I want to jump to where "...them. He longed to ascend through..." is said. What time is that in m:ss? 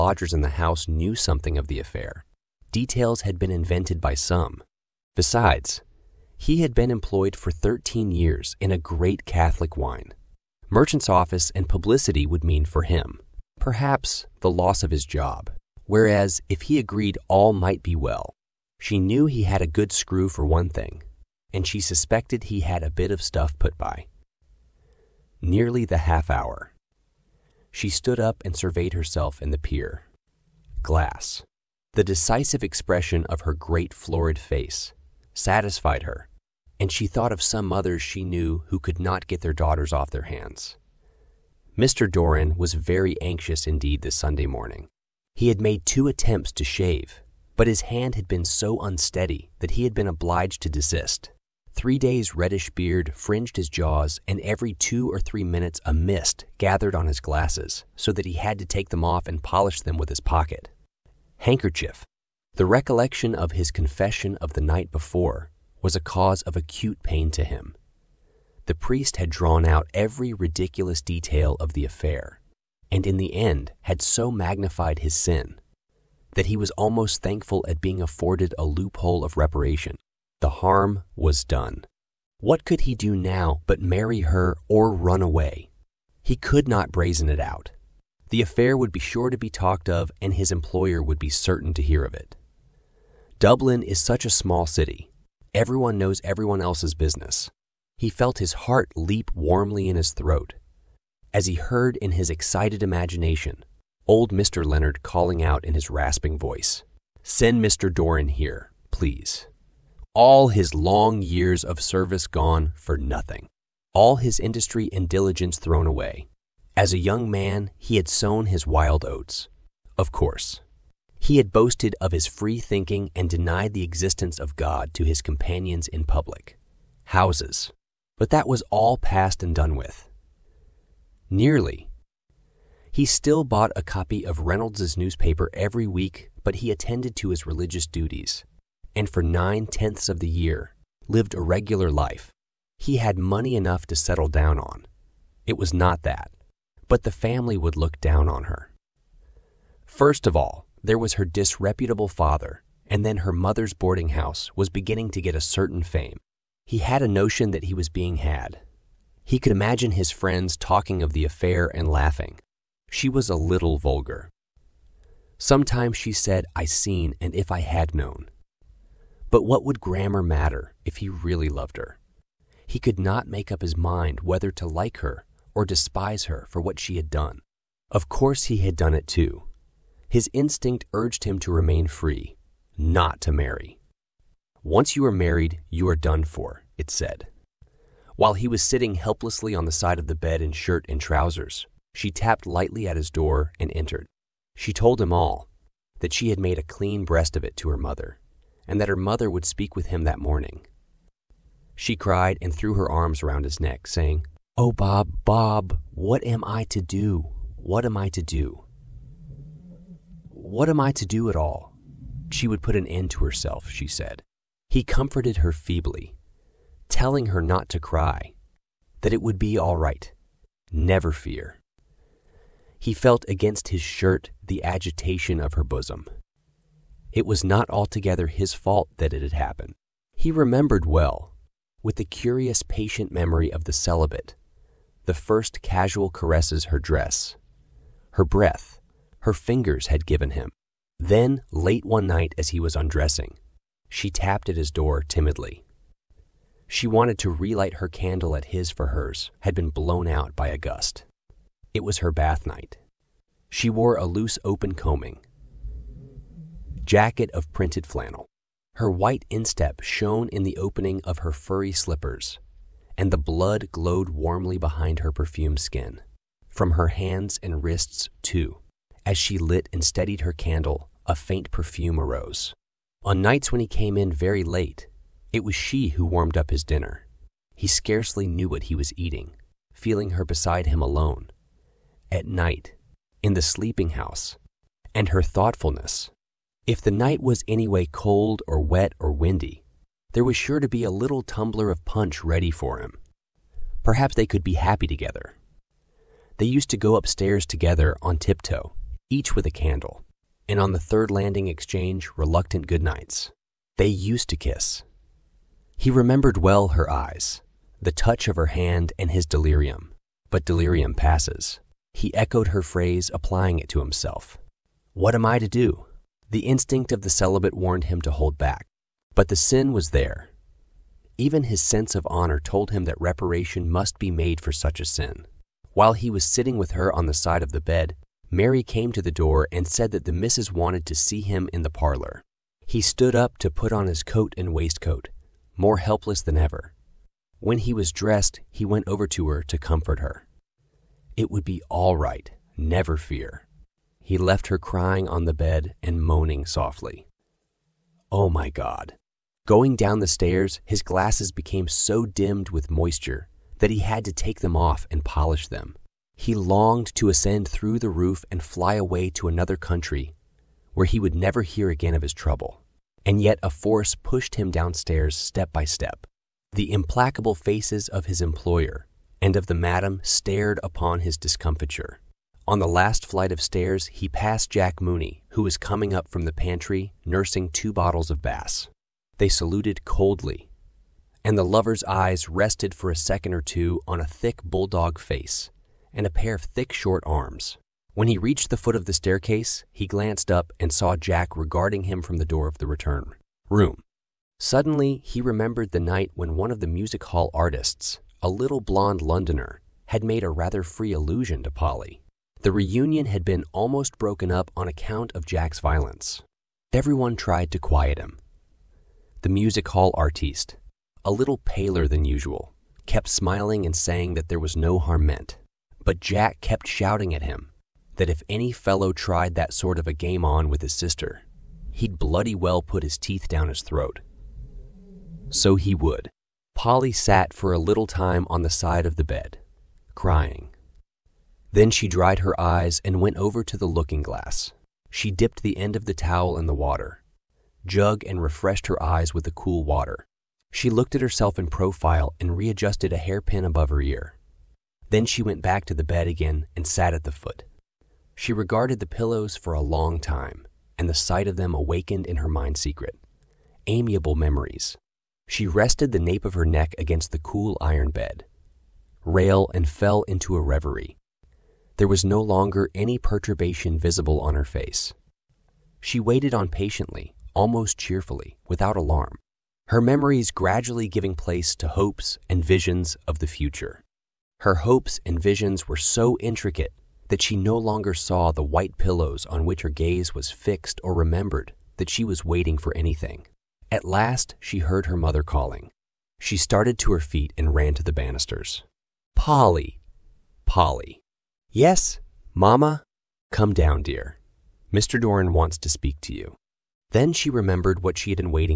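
5:55.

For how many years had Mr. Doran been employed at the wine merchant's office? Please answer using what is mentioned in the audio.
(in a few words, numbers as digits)
13.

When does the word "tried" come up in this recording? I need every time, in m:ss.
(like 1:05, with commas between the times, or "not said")
6:47, 6:58.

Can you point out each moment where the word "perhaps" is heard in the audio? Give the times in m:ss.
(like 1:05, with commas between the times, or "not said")
0:13, 4:53.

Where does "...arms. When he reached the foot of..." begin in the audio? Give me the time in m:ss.
6:27.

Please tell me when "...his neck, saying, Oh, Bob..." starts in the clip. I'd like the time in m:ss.
3:23.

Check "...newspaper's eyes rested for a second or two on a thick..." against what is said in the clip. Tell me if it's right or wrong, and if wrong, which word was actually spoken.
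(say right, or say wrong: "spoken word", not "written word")
wrong: "lover", not "newspaper".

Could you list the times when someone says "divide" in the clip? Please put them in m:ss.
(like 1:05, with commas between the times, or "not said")
not said.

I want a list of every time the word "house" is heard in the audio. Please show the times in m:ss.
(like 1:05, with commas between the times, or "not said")
0:00, 2:07, 2:34, 4:43.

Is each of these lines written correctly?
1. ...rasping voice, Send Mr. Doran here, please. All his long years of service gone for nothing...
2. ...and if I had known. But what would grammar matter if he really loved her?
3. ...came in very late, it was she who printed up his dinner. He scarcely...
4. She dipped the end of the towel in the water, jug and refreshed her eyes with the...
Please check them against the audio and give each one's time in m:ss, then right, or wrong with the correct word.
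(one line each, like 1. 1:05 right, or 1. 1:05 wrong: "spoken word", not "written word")
1. 1:45 right
2. 2:47 right
3. 4:33 wrong: "warmed", not "printed"
4. 7:14 right.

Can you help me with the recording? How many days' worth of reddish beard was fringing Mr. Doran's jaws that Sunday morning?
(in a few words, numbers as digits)
3.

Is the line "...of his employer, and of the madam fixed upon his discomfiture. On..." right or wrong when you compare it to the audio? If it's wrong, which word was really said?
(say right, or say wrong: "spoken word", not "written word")
wrong: "stared", not "fixed".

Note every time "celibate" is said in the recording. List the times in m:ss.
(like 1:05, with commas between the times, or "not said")
3:53, 5:17.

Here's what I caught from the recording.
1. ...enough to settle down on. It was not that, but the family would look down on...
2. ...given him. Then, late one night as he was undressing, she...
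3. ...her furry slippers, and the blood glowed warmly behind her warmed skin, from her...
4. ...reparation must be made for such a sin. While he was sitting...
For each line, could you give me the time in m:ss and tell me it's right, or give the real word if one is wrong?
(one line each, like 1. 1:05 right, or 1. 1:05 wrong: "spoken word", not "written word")
1. 2:23 right
2. 4:00 right
3. 4:21 wrong: "perfumed", not "warmed"
4. 5:23 right.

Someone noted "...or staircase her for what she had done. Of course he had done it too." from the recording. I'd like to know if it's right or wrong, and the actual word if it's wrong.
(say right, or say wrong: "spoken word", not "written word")
wrong: "despise", not "staircase".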